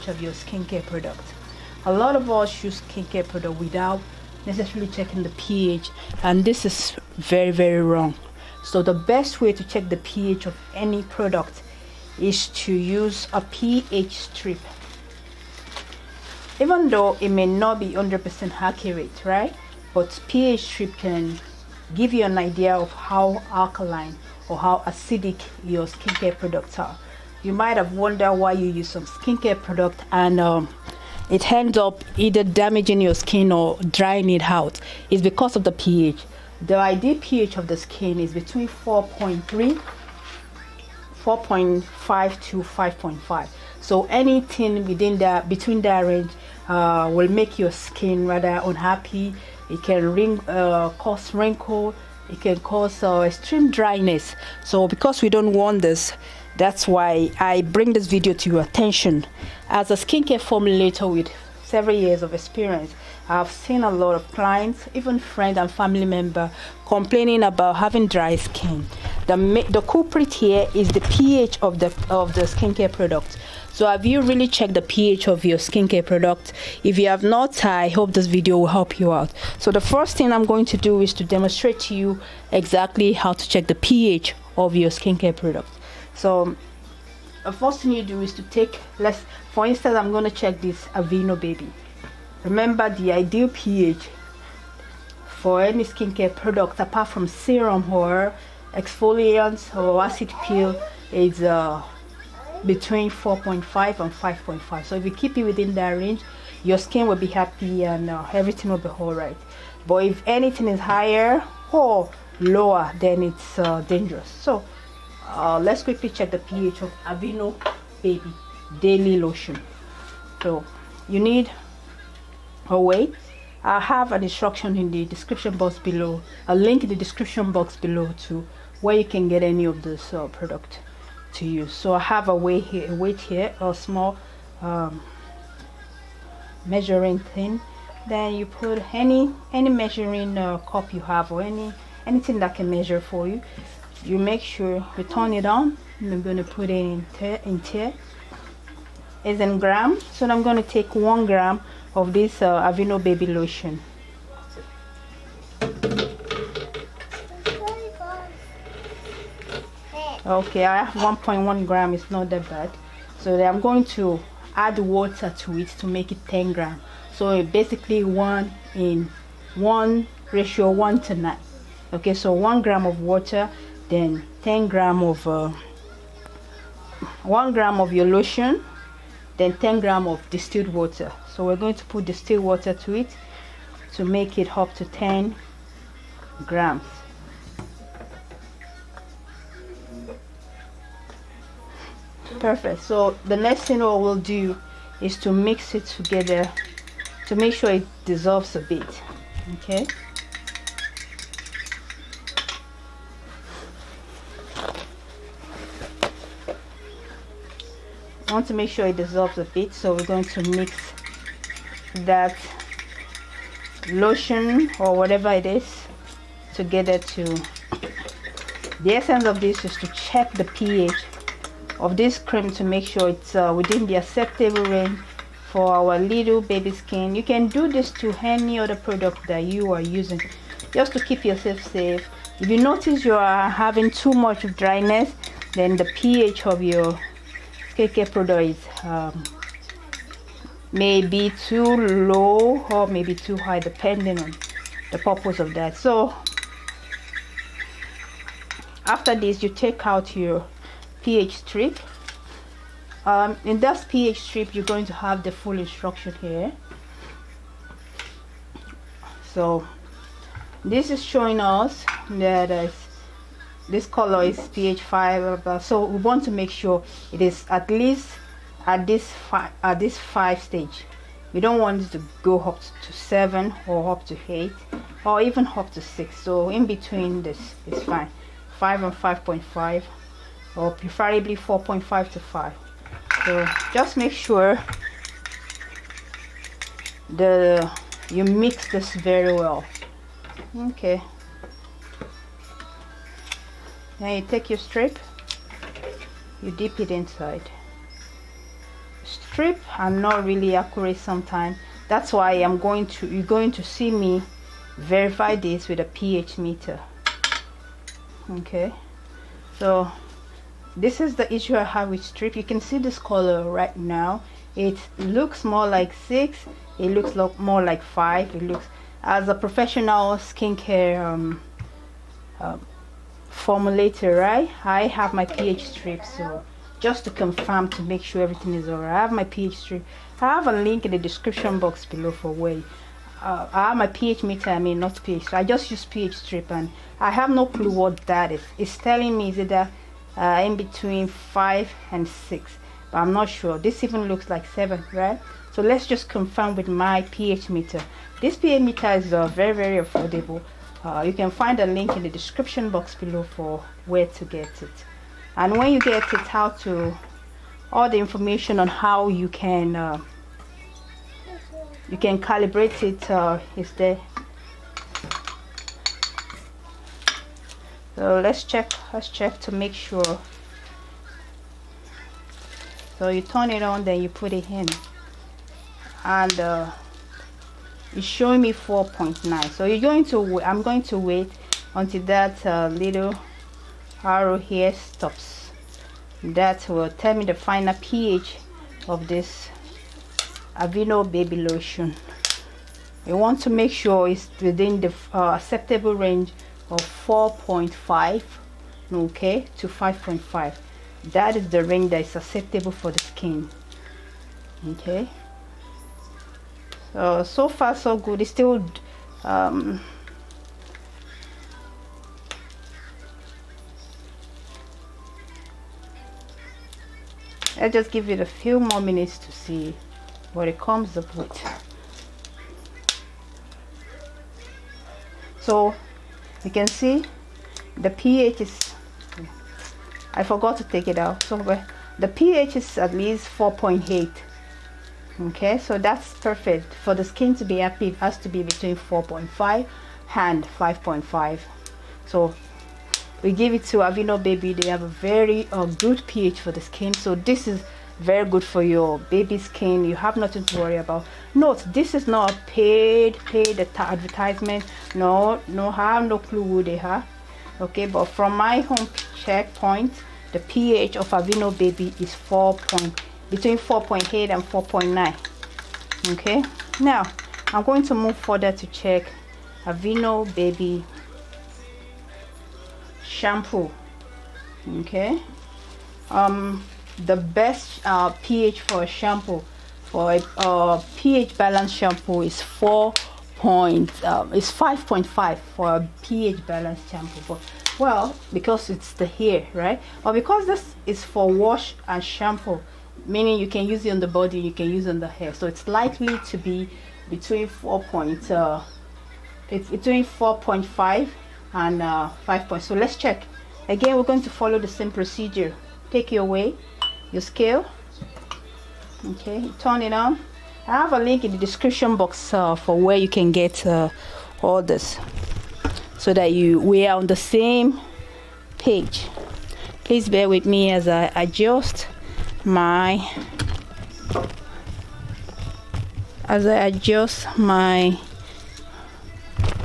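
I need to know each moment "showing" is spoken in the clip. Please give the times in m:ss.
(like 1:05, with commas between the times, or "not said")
4:21, 6:18.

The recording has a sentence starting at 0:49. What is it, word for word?
It can ring, uh, cause wrinkle.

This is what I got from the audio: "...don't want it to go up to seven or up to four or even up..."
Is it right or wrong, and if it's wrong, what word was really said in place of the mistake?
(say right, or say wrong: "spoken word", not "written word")
wrong: "eight", not "four".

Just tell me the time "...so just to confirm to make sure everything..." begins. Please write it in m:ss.
5:26.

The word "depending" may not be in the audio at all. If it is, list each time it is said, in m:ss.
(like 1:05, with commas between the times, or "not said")
4:03.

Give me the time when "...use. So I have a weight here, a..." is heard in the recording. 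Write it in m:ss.
2:11.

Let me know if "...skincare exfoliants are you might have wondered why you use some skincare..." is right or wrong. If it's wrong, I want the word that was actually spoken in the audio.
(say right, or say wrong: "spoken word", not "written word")
wrong: "products", not "exfoliants".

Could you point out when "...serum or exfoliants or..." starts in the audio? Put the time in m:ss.
1:37.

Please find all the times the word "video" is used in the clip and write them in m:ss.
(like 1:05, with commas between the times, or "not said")
0:58, 1:18.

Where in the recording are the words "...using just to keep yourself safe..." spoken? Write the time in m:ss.
3:49.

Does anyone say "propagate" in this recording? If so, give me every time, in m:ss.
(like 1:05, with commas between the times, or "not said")
not said.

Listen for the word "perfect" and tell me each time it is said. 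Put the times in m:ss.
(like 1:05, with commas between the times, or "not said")
3:12, 7:16.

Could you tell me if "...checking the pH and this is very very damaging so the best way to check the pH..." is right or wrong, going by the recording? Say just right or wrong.
wrong.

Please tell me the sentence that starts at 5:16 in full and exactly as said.
It looks lo more like five.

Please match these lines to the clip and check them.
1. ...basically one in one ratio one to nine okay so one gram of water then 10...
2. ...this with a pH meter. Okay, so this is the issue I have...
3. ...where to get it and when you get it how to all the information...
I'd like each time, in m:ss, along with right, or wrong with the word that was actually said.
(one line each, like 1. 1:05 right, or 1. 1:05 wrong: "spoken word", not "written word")
1. 2:47 right
2. 5:05 right
3. 5:53 right.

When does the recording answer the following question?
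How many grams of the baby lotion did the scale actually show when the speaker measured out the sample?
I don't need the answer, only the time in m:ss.
2:40.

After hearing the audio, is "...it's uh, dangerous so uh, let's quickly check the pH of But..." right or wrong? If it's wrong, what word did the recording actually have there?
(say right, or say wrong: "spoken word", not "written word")
wrong: "Aveeno", not "But".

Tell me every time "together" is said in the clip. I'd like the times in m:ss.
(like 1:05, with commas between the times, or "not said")
3:15, 3:36.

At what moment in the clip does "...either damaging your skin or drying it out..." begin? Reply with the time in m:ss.
0:32.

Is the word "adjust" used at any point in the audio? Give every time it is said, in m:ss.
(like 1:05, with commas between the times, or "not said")
8:41, 8:46.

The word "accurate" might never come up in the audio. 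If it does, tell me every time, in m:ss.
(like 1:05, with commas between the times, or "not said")
0:18, 5:00.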